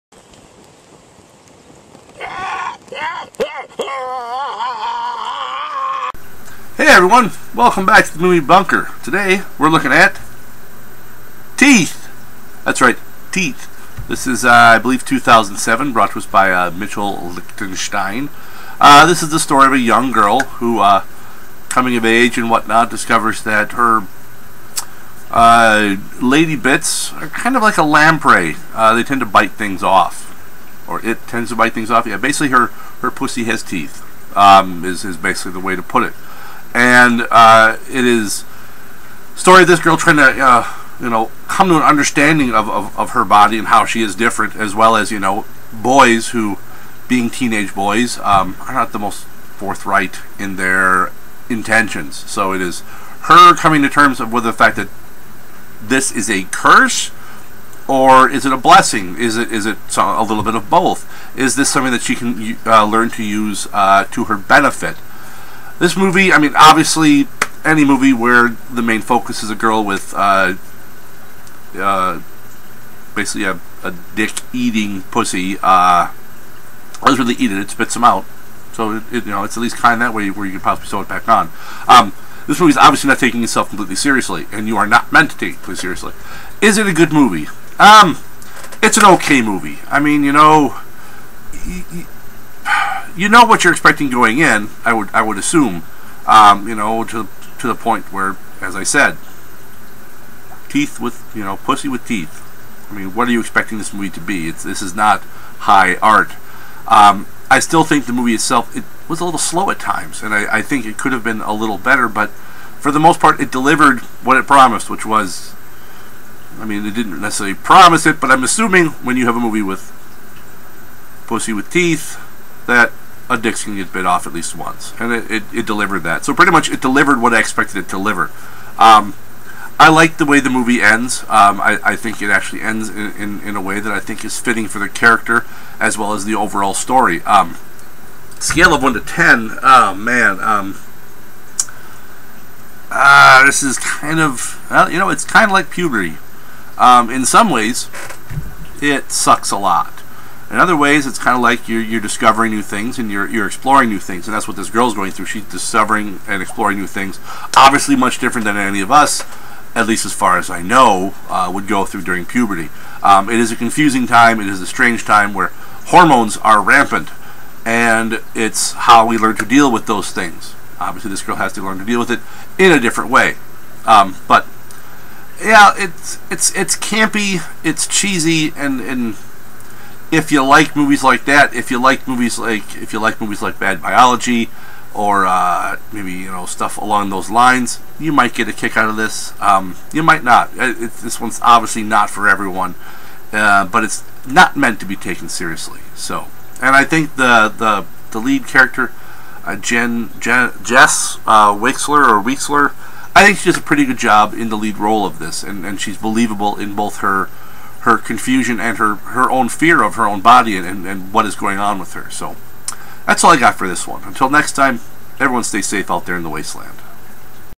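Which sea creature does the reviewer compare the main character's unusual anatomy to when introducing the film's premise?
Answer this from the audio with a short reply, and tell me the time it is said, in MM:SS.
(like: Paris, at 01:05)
lamprey, at 00:27.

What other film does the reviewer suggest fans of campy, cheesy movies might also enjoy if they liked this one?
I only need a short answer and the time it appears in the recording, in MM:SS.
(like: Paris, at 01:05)
Bad Biology, at 03:03.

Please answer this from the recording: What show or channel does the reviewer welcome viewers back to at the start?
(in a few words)
the Movie Bunker.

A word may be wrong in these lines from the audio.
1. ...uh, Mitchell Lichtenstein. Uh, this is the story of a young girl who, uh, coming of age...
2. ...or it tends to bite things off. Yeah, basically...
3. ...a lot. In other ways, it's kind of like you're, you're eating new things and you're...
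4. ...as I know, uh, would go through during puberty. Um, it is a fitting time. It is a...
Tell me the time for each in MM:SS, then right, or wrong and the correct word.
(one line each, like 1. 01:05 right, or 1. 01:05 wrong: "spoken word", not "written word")
1. 00:16 right
2. 00:30 right
3. 02:29 wrong: "discovering", not "eating"
4. 02:40 wrong: "confusing", not "fitting".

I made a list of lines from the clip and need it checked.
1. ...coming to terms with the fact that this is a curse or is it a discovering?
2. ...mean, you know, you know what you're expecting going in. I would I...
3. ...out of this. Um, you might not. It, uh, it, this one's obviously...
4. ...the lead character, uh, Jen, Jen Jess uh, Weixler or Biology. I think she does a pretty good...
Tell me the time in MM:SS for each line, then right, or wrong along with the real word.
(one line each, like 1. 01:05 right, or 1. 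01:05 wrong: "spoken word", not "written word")
1. 00:53 wrong: "blessing", not "discovering"
2. 01:29 right
3. 03:08 right
4. 03:18 wrong: "Weixler", not "Biology".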